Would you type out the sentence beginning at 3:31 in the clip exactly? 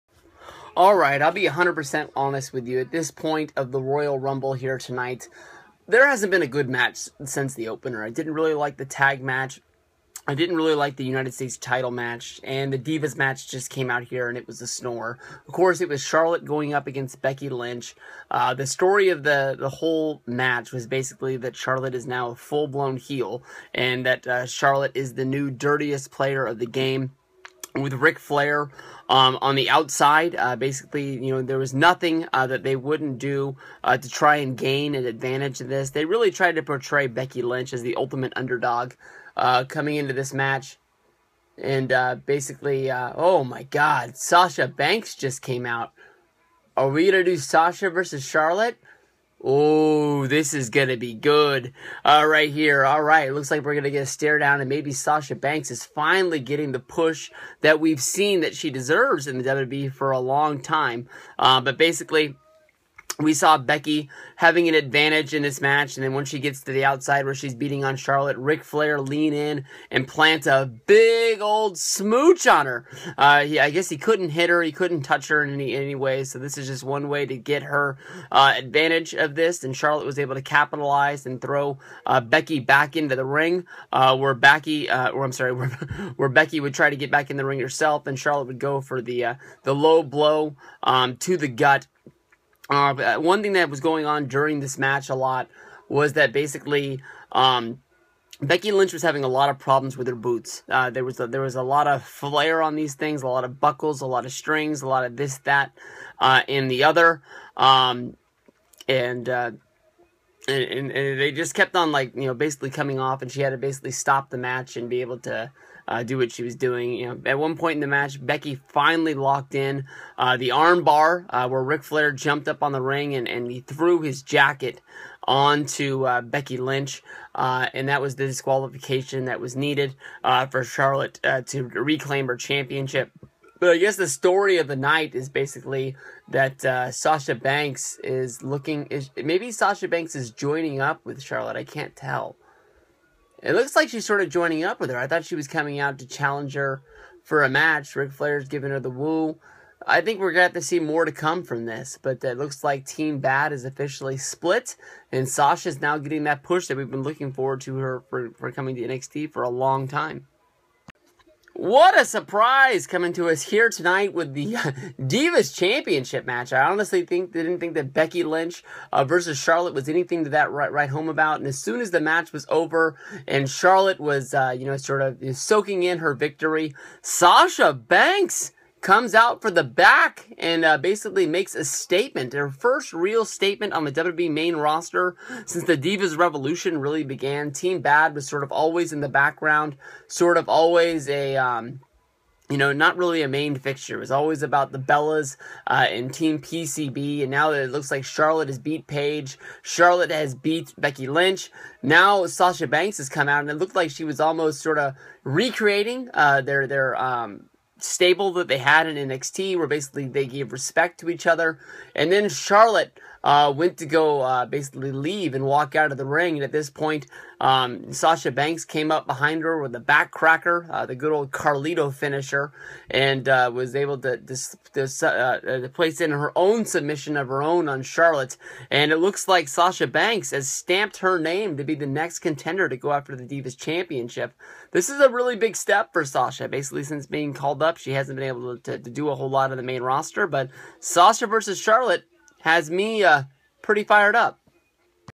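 And then Charlotte uh, went to go uh, basically leave and walk out of the ring.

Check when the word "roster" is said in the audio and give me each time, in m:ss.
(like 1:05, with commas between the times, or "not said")
3:04, 3:59.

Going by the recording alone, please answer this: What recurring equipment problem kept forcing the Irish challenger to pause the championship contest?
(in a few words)
Her boots.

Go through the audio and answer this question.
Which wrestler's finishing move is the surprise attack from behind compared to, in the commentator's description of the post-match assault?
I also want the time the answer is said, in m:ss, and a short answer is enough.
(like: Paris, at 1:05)
Carlito, at 3:41.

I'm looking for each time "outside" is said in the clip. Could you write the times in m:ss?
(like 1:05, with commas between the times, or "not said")
0:29, 1:06.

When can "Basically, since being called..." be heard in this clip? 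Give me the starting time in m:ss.
3:56.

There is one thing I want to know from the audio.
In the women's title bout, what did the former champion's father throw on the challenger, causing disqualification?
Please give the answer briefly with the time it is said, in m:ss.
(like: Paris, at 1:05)
His jacket, at 2:04.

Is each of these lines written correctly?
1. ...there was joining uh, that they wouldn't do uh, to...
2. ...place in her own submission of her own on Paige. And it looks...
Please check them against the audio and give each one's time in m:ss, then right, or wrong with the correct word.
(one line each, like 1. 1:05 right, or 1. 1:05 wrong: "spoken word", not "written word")
1. 0:31 wrong: "nothing", not "joining"
2. 3:45 wrong: "Charlotte", not "Paige".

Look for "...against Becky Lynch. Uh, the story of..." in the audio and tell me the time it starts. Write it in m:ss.
0:16.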